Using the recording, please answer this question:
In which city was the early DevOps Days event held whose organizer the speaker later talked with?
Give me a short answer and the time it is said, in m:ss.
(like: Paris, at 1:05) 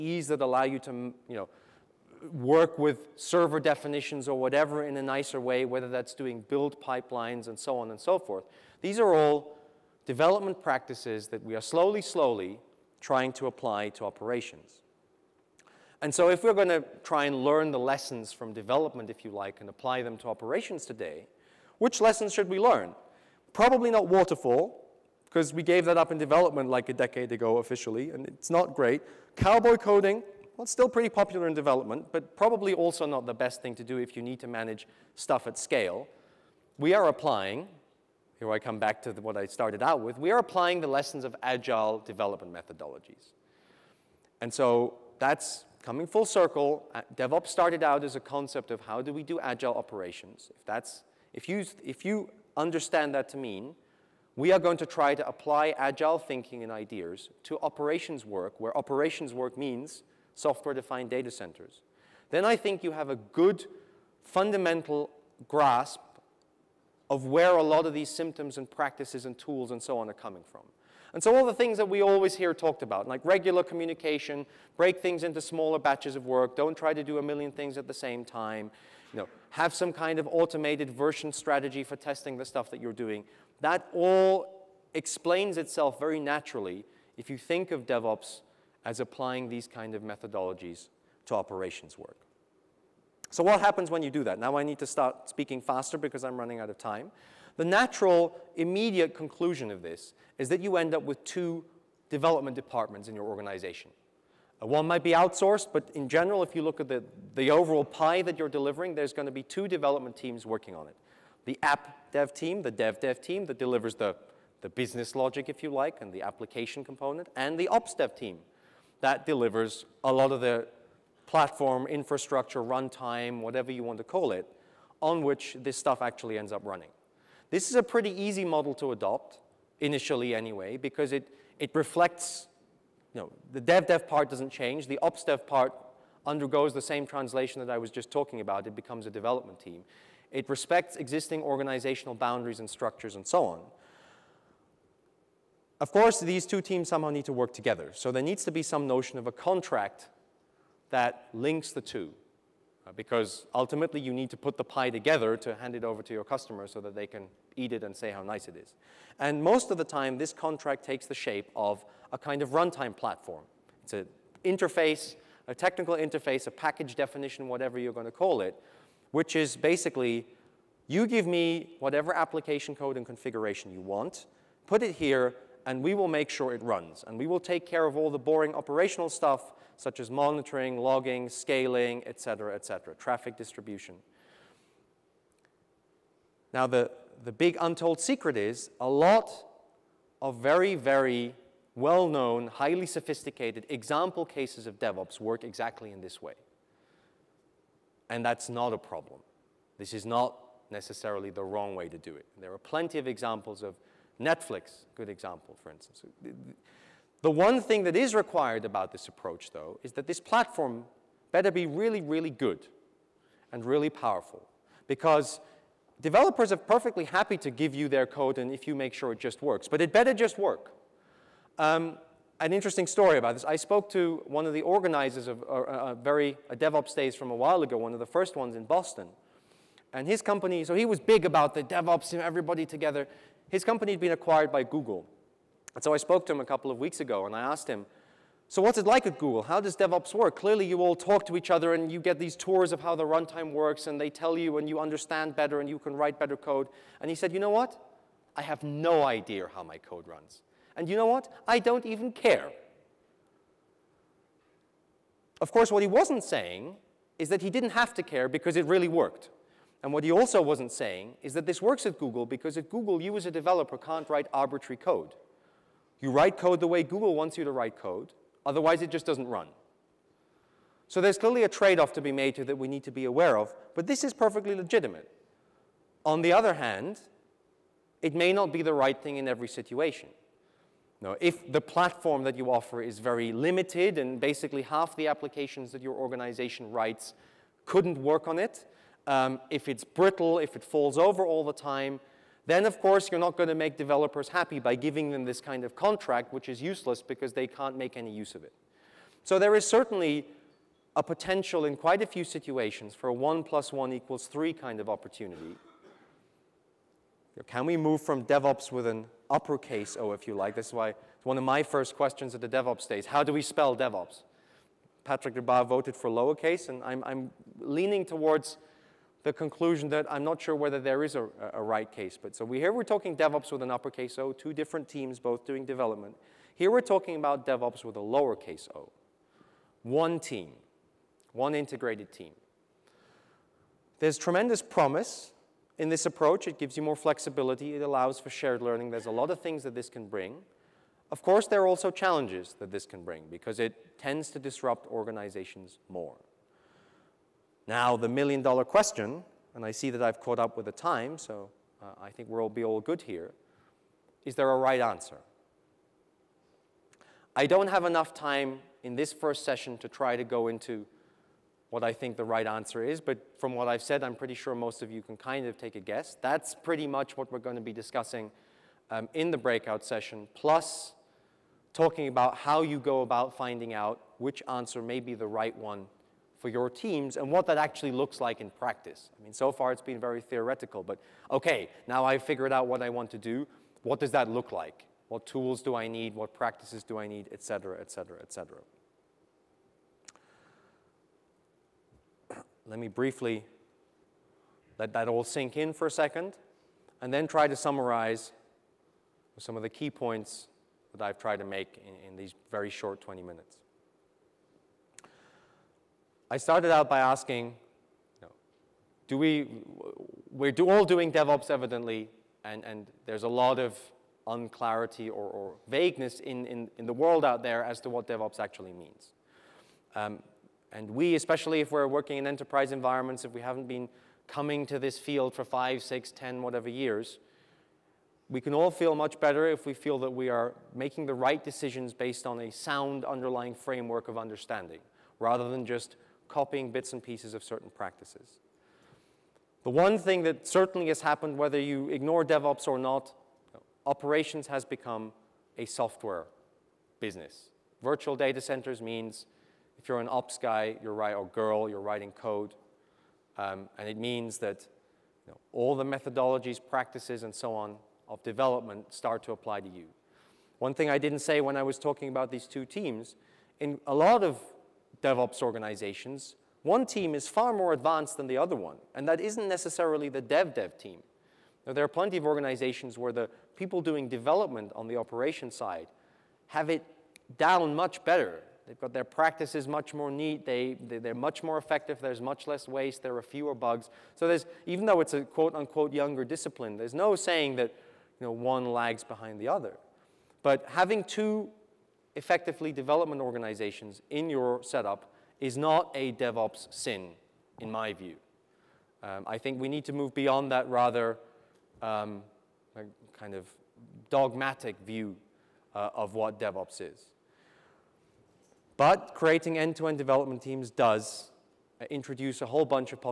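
Boston, at 3:48.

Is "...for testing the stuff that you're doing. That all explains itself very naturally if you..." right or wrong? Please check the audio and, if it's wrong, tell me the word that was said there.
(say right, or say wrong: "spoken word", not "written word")
right.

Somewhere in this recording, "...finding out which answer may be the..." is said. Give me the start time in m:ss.
6:13.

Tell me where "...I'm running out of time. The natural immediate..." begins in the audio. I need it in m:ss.
1:36.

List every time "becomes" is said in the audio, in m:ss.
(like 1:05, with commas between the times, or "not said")
2:18, 7:24.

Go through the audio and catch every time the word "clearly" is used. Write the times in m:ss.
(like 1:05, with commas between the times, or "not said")
4:00, 4:31.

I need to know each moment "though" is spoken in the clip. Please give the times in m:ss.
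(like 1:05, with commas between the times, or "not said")
3:29, 8:04.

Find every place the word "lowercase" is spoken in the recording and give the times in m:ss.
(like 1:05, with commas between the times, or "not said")
5:16, 5:28.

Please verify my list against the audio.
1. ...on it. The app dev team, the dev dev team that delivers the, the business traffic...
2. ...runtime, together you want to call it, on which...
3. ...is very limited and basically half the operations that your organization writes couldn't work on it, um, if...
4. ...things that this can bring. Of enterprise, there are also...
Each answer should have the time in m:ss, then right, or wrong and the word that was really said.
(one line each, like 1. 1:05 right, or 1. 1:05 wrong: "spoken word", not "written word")
1. 1:50 wrong: "logic", not "traffic"
2. 2:02 wrong: "whatever", not "together"
3. 4:42 wrong: "applications", not "operations"
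4. 5:39 wrong: "course", not "enterprise".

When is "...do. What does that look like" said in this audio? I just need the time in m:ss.
6:23.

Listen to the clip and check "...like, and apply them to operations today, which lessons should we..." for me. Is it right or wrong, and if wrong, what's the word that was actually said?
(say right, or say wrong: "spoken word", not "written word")
right.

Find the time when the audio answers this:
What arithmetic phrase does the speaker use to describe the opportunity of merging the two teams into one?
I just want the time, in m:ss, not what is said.
5:03.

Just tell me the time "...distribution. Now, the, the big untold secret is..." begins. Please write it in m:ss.
3:03.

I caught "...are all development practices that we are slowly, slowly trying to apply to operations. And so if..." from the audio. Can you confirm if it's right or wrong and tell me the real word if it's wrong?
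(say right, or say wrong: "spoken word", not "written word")
right.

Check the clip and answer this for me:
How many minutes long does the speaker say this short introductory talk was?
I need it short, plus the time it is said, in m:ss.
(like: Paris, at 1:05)
20, at 6:43.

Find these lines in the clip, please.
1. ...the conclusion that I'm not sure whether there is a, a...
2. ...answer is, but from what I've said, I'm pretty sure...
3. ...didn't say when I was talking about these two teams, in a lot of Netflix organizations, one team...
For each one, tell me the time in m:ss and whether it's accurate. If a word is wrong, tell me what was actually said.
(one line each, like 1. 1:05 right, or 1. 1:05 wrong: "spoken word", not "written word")
1. 5:19 right
2. 6:02 right
3. 7:40 wrong: "DevOps", not "Netflix".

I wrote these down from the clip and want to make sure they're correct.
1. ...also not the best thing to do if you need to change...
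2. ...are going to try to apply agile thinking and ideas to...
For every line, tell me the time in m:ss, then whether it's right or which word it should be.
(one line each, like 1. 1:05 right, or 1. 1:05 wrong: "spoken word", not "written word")
1. 0:32 wrong: "manage", not "change"
2. 0:54 right.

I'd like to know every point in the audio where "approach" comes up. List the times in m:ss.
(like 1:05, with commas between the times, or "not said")
3:29, 5:36.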